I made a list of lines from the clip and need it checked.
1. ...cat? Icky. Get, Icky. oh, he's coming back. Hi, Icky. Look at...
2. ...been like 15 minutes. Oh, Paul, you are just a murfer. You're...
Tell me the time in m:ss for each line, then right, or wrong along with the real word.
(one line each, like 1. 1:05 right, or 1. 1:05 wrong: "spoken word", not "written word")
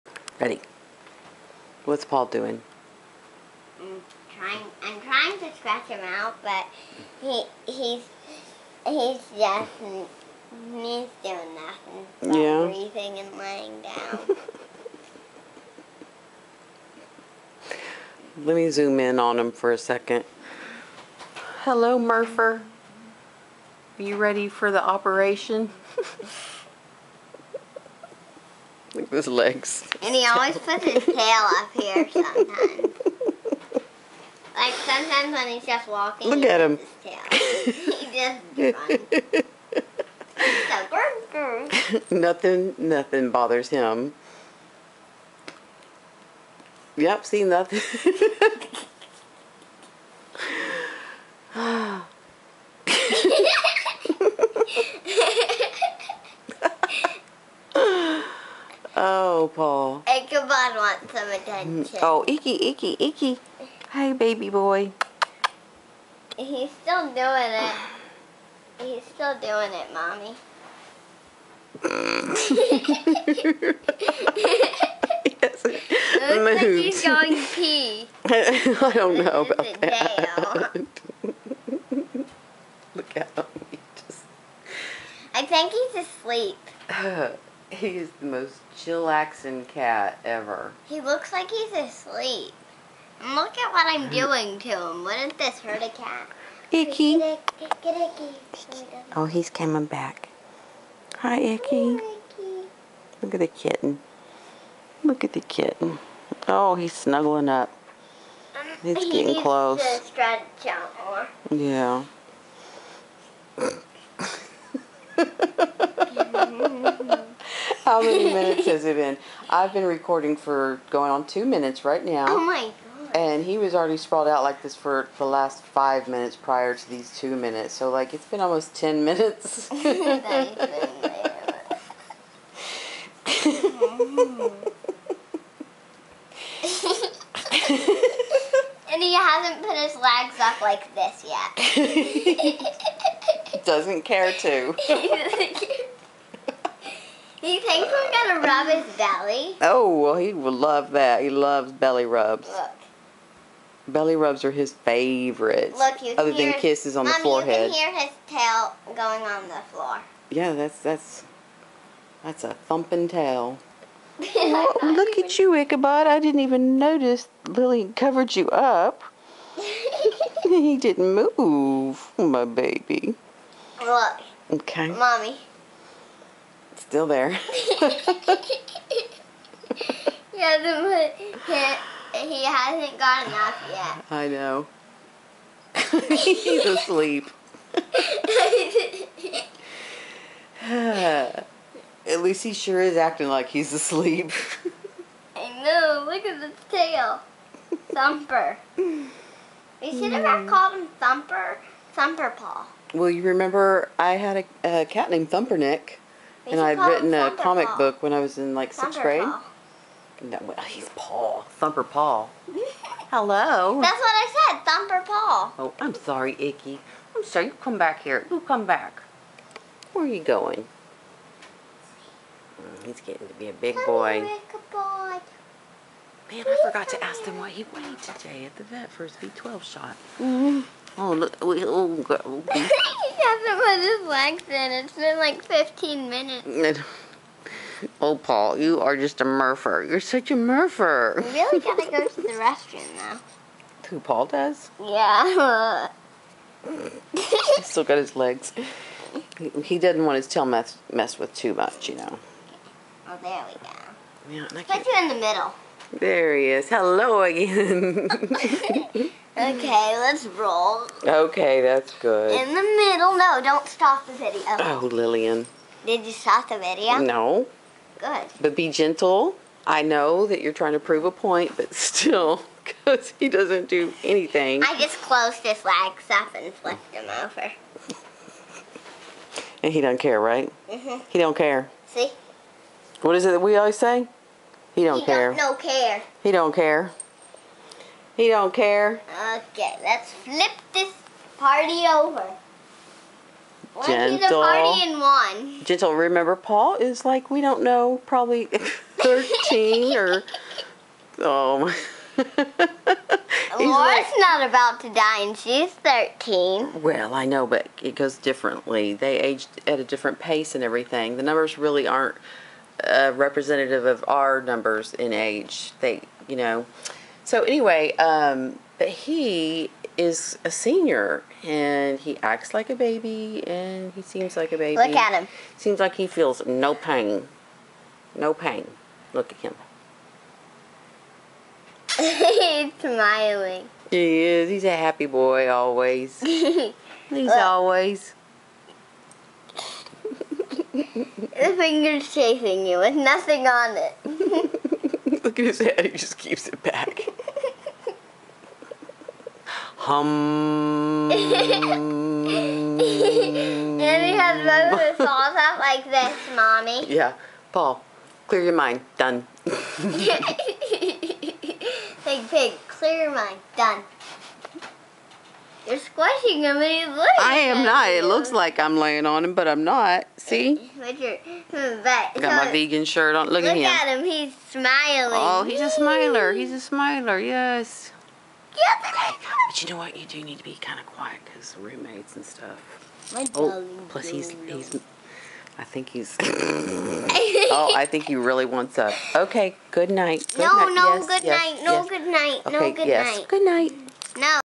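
1. 1:35 right
2. 3:54 right.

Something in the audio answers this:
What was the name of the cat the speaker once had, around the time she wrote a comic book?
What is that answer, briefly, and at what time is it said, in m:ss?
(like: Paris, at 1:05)
Thumpernick, at 3:25.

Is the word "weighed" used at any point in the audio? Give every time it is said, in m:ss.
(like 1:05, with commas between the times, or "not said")
3:47.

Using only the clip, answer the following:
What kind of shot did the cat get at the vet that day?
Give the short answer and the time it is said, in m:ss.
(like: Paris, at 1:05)
B12, at 3:49.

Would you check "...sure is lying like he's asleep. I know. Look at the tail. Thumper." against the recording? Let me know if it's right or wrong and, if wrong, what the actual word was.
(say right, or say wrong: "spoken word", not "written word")
wrong: "acting", not "lying".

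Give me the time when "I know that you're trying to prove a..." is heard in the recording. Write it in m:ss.
4:29.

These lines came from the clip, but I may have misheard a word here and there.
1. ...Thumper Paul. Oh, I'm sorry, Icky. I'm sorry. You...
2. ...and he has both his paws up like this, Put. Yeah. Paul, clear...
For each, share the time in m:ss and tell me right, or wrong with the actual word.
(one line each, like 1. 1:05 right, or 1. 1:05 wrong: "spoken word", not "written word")
1. 3:34 right
2. 5:51 wrong: "Mommy", not "Put".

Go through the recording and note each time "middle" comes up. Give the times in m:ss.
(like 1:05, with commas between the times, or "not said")
4:15, 4:22.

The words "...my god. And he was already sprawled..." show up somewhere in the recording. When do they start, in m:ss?
2:02.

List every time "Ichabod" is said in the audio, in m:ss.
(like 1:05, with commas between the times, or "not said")
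1:00, 2:45.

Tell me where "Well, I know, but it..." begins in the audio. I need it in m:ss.
5:06.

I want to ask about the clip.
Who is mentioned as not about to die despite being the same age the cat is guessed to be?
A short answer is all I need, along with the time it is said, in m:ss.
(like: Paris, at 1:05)
Laura, at 5:03.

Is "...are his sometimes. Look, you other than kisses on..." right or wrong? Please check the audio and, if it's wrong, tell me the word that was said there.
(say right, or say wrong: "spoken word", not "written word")
wrong: "favorites", not "sometimes".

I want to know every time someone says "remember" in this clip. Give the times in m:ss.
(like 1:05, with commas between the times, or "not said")
3:23, 4:55.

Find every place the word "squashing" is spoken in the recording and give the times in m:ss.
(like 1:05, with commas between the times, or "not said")
6:05.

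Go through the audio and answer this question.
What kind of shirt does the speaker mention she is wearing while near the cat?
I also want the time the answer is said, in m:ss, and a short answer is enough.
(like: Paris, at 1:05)
vegan shirt, at 6:12.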